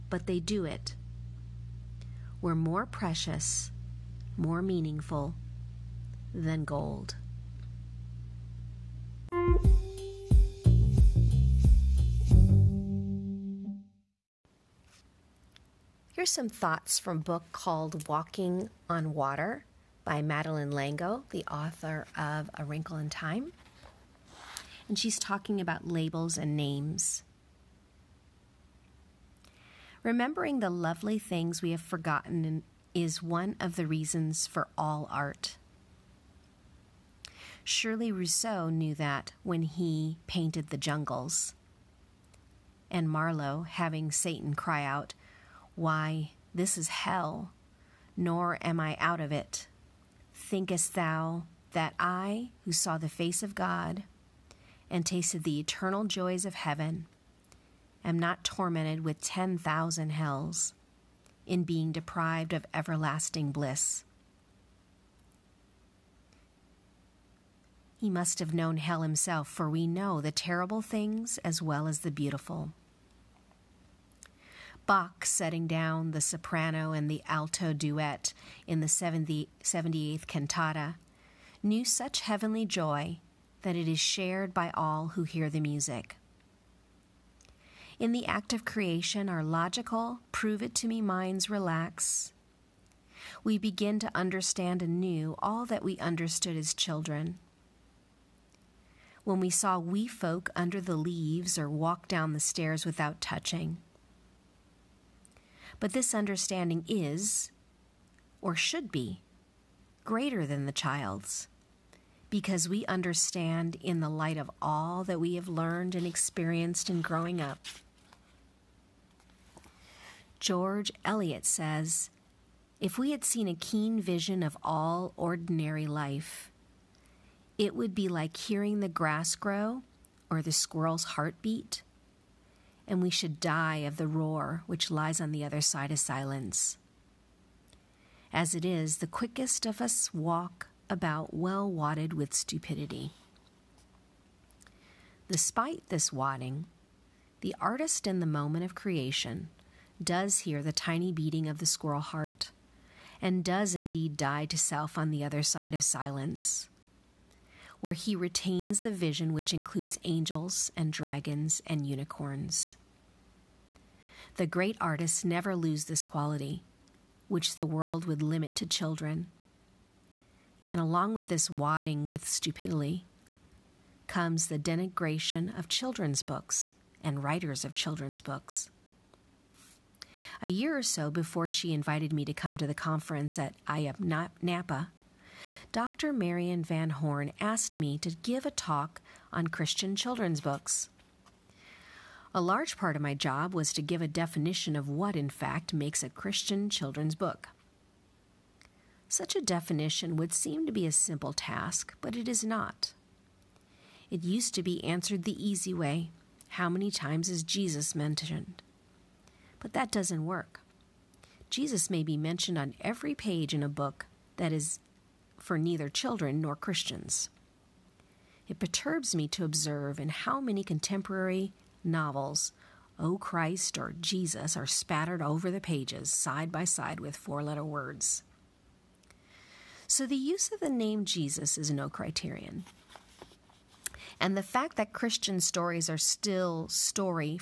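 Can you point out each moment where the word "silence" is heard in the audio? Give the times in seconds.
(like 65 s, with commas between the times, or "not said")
135 s, 155 s.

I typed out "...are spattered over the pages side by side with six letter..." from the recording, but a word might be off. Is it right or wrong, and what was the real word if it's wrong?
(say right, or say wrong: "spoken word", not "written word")
wrong: "four", not "six".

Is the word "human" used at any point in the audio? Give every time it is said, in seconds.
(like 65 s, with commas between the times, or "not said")
not said.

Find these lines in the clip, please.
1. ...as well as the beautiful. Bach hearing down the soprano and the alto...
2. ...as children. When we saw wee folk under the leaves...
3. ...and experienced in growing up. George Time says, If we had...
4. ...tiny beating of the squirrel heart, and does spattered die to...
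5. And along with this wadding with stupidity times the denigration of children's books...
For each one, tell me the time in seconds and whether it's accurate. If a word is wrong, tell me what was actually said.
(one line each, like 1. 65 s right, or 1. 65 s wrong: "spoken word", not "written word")
1. 71 s wrong: "setting", not "hearing"
2. 96 s right
3. 115 s wrong: "Eliot", not "Time"
4. 150 s wrong: "indeed", not "spattered"
5. 170 s wrong: "comes", not "times".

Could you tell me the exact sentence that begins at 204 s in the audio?
It used to be answered the easy way how many times is Jesus mentioned?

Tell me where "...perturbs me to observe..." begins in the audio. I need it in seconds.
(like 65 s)
218 s.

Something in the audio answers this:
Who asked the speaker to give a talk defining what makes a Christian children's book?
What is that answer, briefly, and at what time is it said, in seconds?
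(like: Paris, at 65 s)
Dr. Marion Van Horn, at 185 s.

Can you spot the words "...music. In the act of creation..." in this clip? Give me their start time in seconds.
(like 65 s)
85 s.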